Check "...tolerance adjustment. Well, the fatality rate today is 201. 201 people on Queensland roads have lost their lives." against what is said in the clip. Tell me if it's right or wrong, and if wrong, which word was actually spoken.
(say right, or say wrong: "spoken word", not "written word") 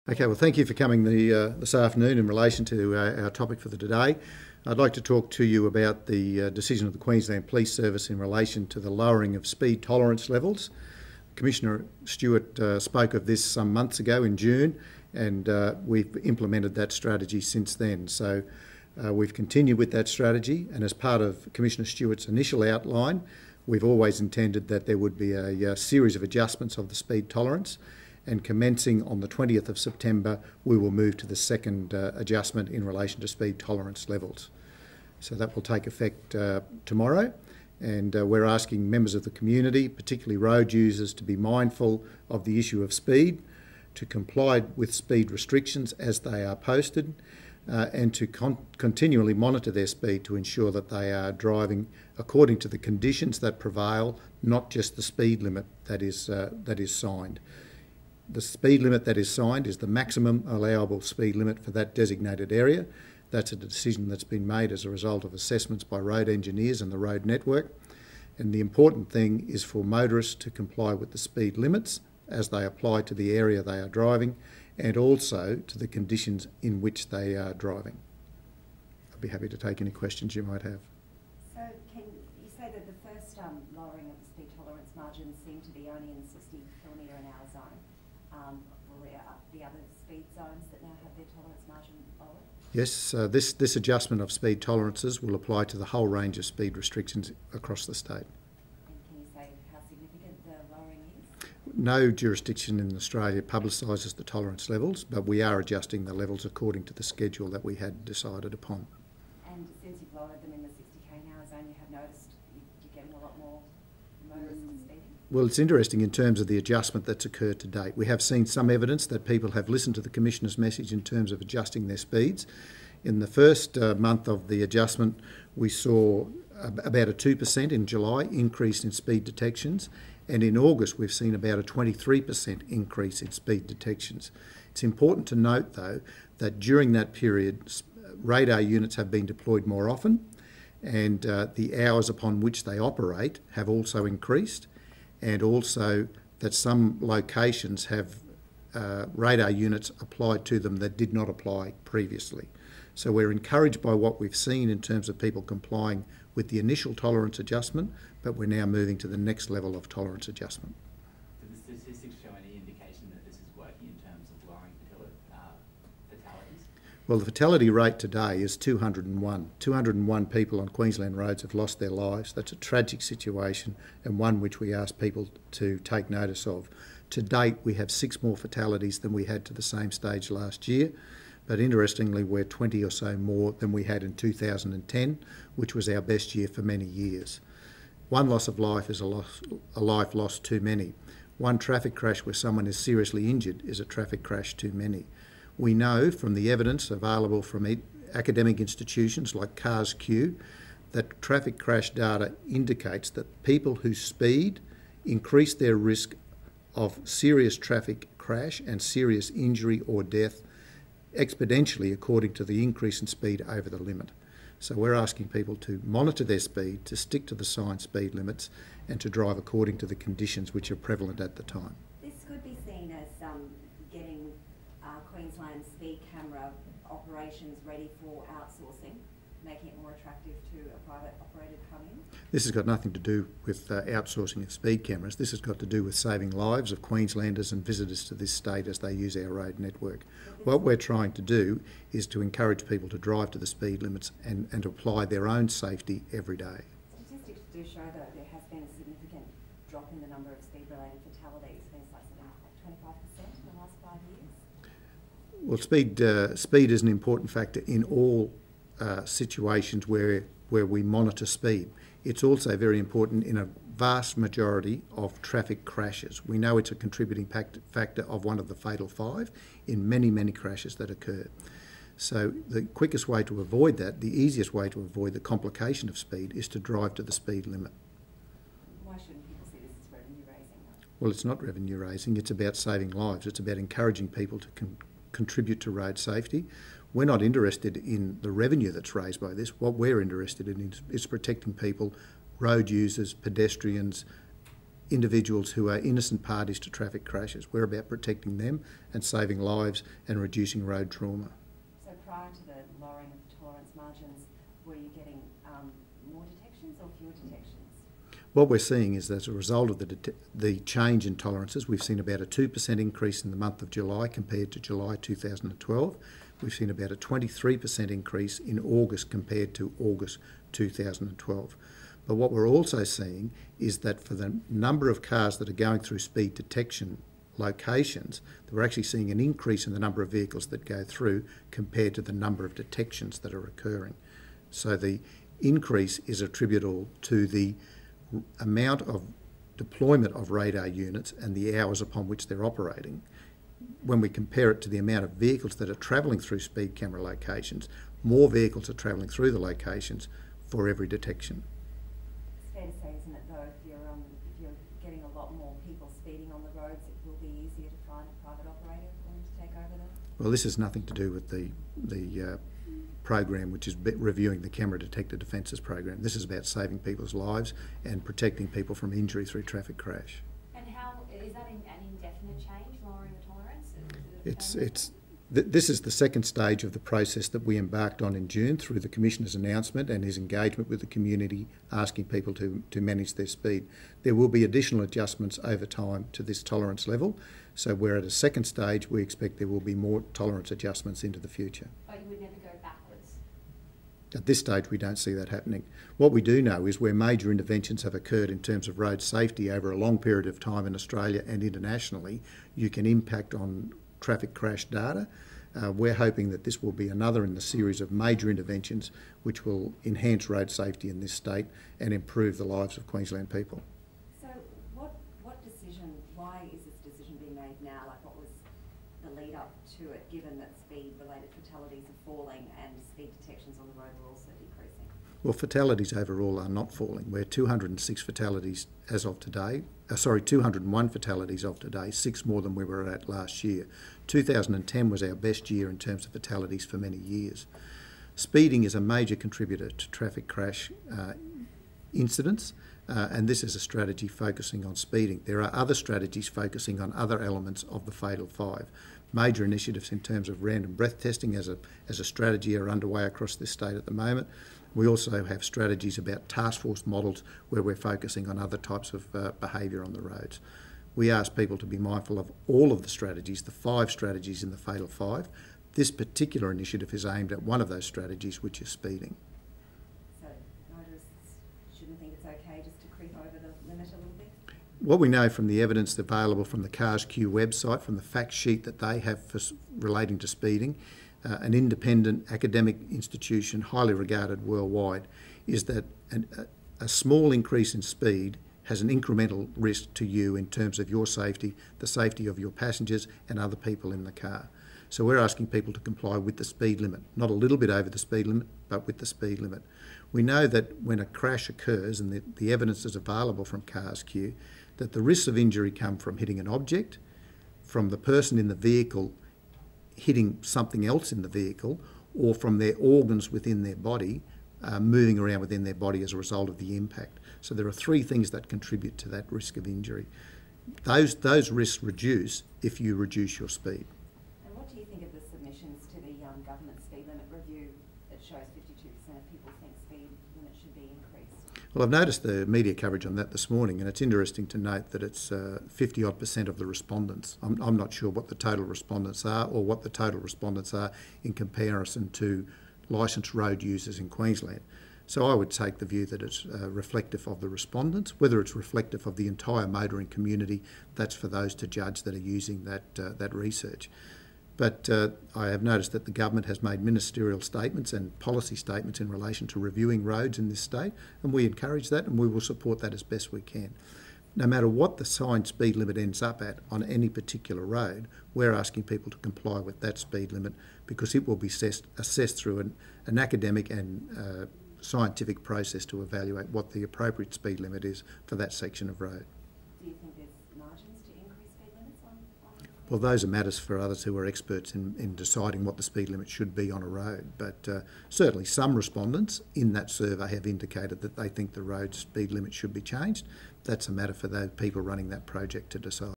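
right.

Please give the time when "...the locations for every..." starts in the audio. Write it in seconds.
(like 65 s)
349 s.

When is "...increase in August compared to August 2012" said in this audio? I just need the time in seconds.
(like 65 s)
317 s.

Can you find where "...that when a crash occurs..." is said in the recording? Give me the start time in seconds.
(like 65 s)
500 s.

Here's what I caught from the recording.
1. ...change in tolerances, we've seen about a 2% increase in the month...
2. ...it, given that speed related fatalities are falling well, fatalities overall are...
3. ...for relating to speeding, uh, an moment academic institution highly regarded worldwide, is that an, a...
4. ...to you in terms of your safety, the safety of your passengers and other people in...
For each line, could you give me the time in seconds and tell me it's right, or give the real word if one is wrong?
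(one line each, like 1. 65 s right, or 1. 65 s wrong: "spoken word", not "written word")
1. 310 s right
2. 419 s right
3. 479 s wrong: "independent", not "moment"
4. 489 s right.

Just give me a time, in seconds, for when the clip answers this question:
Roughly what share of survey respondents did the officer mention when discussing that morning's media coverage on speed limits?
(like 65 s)
535 s.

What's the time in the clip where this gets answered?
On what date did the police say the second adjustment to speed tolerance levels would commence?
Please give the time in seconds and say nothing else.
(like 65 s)
29 s.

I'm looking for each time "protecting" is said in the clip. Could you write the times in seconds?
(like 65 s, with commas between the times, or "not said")
291 s, 297 s, 368 s.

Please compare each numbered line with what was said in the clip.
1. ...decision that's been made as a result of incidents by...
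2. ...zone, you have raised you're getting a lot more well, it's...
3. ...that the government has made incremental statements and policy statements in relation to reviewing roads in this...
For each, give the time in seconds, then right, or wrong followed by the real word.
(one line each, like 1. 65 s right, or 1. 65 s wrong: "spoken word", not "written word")
1. 63 s wrong: "assessments", not "incidents"
2. 111 s wrong: "noticed", not "raised"
3. 555 s wrong: "ministerial", not "incremental".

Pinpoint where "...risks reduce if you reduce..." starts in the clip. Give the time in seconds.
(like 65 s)
521 s.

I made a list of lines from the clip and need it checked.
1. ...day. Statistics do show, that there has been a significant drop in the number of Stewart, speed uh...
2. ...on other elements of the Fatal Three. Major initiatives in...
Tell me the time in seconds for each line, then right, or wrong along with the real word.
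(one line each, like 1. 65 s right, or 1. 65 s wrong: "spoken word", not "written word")
1. 246 s wrong: "Well", not "Stewart"
2. 446 s wrong: "Five", not "Three".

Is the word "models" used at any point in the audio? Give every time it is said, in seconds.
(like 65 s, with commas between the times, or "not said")
456 s.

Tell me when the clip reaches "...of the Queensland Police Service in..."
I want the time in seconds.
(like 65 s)
6 s.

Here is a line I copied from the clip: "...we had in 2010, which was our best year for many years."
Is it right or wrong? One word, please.
right.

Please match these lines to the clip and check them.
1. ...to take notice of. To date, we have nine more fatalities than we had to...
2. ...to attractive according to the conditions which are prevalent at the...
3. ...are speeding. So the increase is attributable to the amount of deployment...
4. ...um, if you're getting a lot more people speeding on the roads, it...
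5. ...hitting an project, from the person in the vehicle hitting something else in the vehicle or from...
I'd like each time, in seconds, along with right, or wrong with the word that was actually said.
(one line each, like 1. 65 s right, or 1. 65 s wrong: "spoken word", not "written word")
1. 175 s wrong: "six", not "nine"
2. 218 s wrong: "drive", not "attractive"
3. 333 s wrong: "occurring", not "speeding"
4. 353 s right
5. 506 s wrong: "object", not "project".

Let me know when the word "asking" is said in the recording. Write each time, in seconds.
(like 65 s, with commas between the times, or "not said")
38 s, 214 s, 381 s, 495 s, 568 s.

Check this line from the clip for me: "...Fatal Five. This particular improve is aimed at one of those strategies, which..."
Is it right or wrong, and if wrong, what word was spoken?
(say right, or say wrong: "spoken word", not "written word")
wrong: "initiative", not "improve".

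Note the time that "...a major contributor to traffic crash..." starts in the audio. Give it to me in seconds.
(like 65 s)
438 s.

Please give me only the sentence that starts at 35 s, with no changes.
So that will take effect uh, tomorrow.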